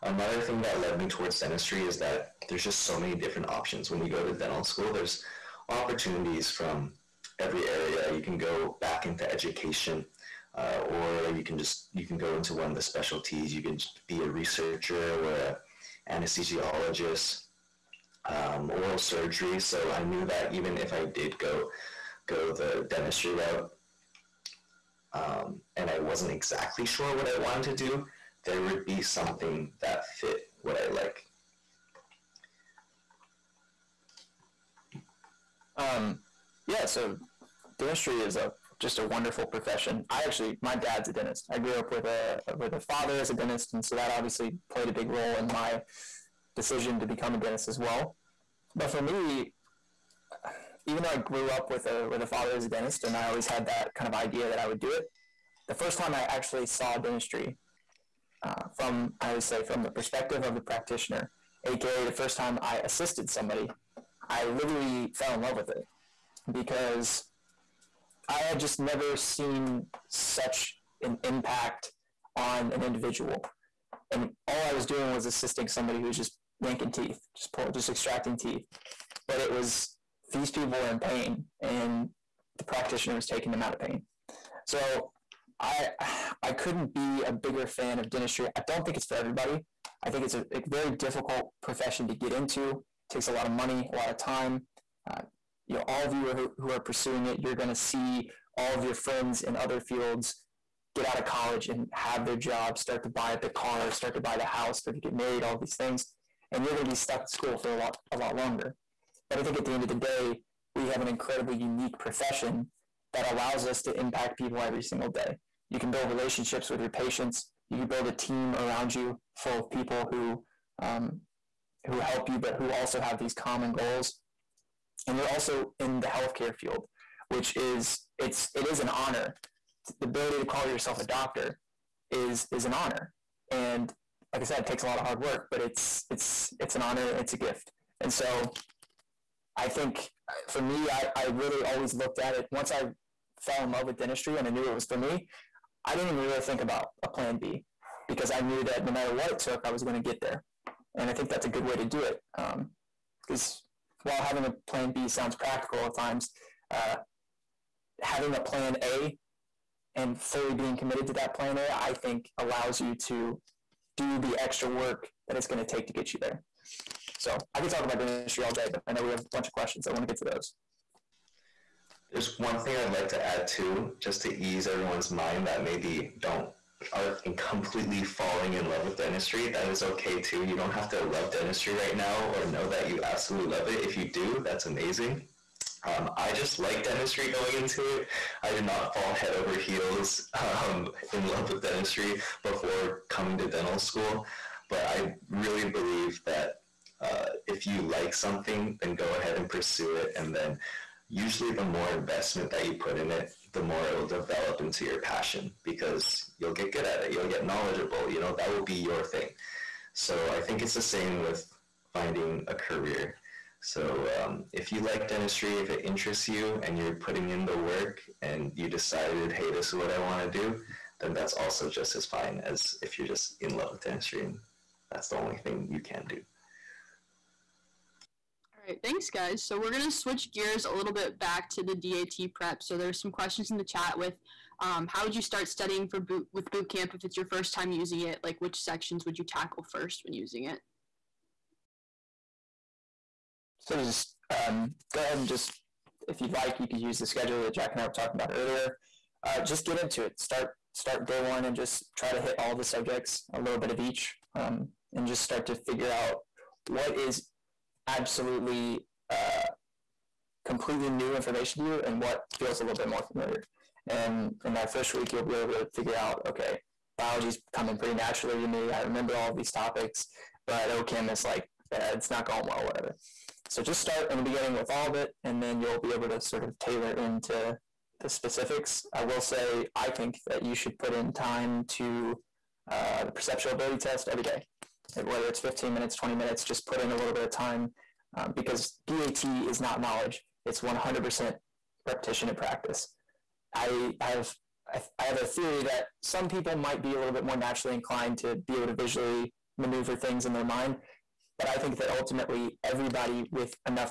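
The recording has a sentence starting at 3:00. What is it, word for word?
You don't have to love dentistry right now or know that you absolutely love it.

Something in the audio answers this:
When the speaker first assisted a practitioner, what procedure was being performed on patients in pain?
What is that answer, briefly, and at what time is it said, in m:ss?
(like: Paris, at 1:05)
Extracting teeth, at 1:17.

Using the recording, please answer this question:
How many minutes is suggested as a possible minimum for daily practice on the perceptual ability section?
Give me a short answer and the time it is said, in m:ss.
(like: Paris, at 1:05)
15, at 4:45.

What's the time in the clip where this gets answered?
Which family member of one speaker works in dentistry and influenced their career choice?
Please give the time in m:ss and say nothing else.
0:40.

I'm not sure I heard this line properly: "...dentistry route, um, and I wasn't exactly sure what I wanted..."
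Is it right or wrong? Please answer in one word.
right.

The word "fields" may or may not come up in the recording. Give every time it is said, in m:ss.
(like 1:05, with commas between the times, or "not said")
1:39, 2:06.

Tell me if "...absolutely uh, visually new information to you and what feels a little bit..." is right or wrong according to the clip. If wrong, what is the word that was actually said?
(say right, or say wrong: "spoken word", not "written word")
wrong: "completely", not "visually".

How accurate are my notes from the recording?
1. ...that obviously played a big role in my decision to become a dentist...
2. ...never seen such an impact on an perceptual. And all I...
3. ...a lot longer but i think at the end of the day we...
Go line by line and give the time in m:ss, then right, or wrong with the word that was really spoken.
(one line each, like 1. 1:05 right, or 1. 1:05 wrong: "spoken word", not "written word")
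1. 0:43 right
2. 1:08 wrong: "individual", not "perceptual"
3. 1:48 right.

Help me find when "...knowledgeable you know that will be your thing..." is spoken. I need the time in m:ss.
3:27.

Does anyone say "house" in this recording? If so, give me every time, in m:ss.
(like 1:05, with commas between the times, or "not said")
1:44.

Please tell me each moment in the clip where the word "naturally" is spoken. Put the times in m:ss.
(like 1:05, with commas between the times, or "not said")
4:27, 4:57.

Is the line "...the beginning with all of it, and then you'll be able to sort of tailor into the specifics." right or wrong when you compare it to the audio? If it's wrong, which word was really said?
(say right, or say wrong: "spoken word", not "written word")
right.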